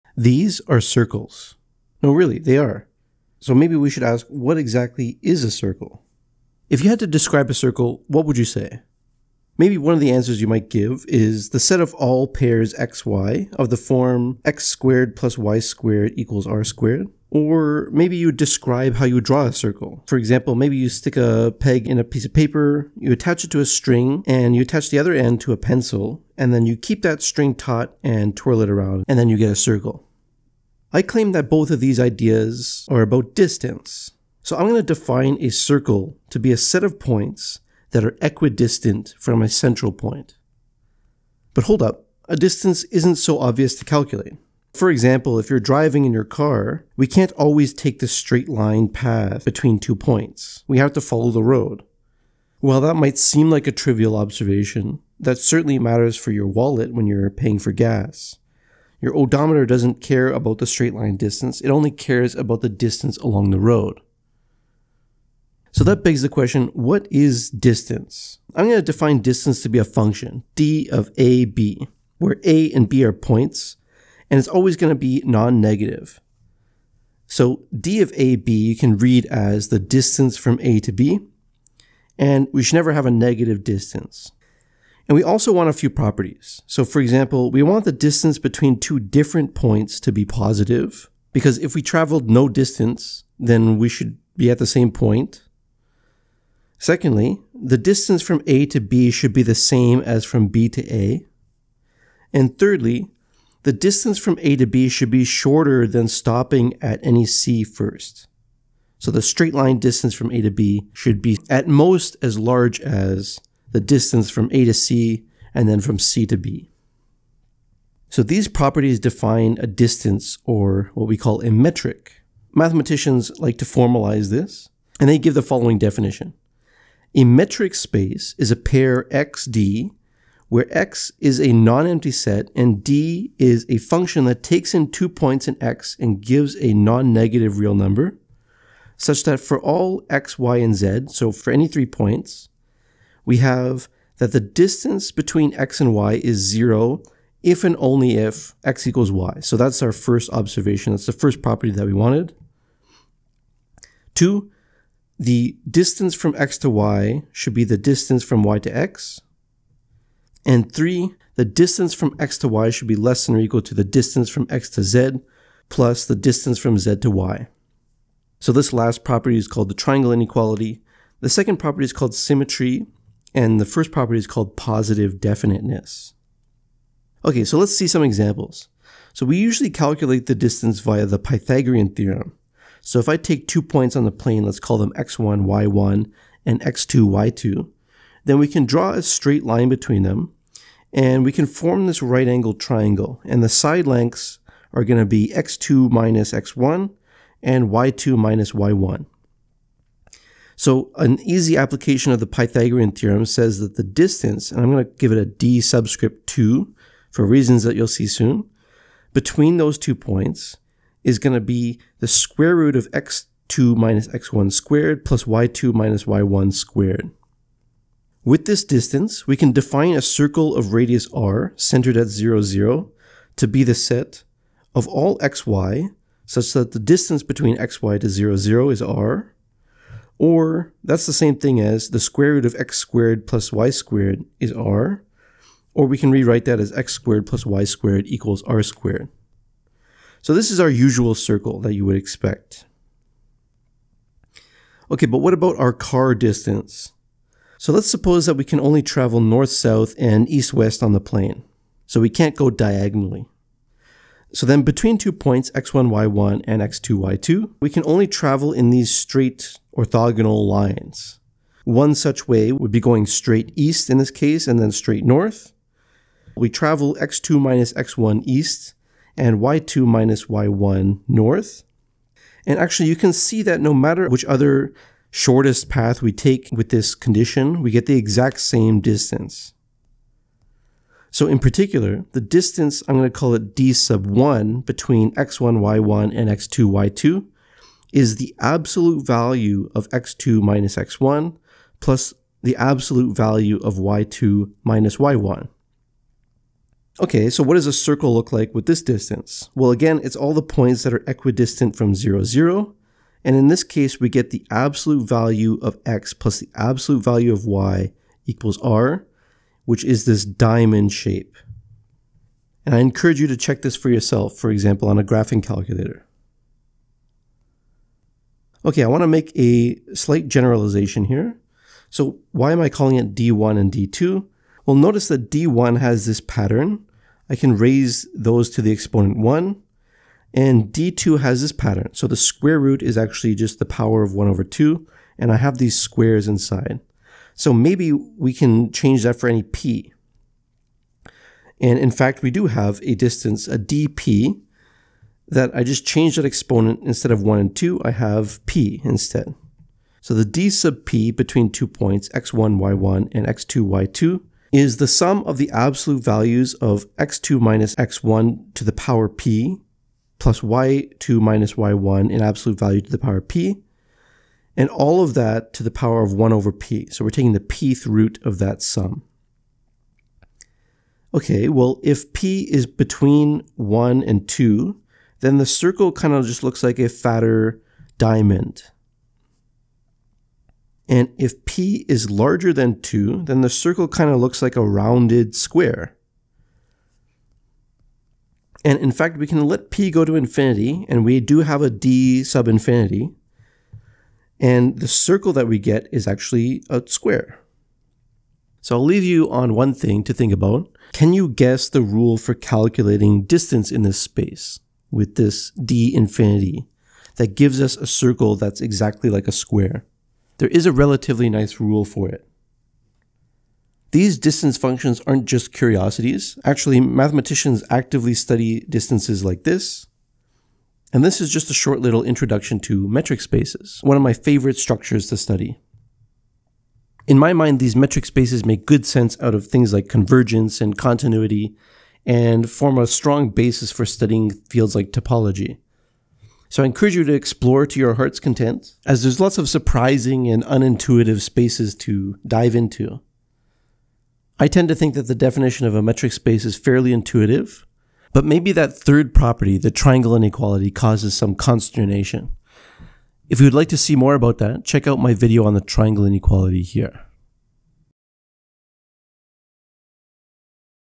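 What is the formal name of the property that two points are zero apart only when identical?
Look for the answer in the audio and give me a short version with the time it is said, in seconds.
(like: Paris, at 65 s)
Positive definiteness, at 174 s.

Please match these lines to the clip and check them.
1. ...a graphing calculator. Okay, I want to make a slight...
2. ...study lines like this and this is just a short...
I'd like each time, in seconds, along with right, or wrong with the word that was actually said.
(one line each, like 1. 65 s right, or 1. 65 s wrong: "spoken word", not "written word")
1. 314 s right
2. 418 s wrong: "distances", not "lines".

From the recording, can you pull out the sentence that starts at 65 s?
So that begs the question what is distance?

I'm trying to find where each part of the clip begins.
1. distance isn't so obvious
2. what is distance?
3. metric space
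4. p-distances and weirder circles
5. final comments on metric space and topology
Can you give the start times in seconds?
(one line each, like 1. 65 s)
1. 41 s
2. 65 s
3. 125 s
4. 320 s
5. 414 s.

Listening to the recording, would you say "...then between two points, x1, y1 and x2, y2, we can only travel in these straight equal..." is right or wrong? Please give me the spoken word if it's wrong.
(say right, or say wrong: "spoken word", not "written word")
wrong: "orthogonal", not "equal".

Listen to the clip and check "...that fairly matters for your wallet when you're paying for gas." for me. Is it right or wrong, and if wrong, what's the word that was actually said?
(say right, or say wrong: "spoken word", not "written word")
wrong: "certainly", not "fairly".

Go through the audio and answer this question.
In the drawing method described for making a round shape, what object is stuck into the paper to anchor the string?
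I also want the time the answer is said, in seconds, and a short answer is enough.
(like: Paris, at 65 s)
A peg, at 21 s.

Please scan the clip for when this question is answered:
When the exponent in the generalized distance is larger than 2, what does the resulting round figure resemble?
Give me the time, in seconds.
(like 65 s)
384 s.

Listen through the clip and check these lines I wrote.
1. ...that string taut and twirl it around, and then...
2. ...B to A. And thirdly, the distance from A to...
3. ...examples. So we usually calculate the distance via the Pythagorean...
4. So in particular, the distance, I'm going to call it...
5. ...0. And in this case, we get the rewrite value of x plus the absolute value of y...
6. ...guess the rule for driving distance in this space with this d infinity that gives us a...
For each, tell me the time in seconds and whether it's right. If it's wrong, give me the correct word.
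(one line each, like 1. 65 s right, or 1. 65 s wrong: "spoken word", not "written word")
1. 27 s right
2. 100 s right
3. 178 s right
4. 281 s right
5. 302 s wrong: "absolute", not "rewrite"
6. 401 s wrong: "calculating", not "driving".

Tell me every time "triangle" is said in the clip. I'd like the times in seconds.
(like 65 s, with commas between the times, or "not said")
169 s, 192 s, 449 s, 455 s.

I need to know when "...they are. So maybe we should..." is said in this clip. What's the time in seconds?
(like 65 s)
2 s.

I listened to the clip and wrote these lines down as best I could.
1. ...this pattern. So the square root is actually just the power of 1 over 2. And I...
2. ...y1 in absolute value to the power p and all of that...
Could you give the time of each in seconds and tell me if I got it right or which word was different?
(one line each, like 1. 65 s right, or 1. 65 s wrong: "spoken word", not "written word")
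1. 331 s right
2. 361 s right.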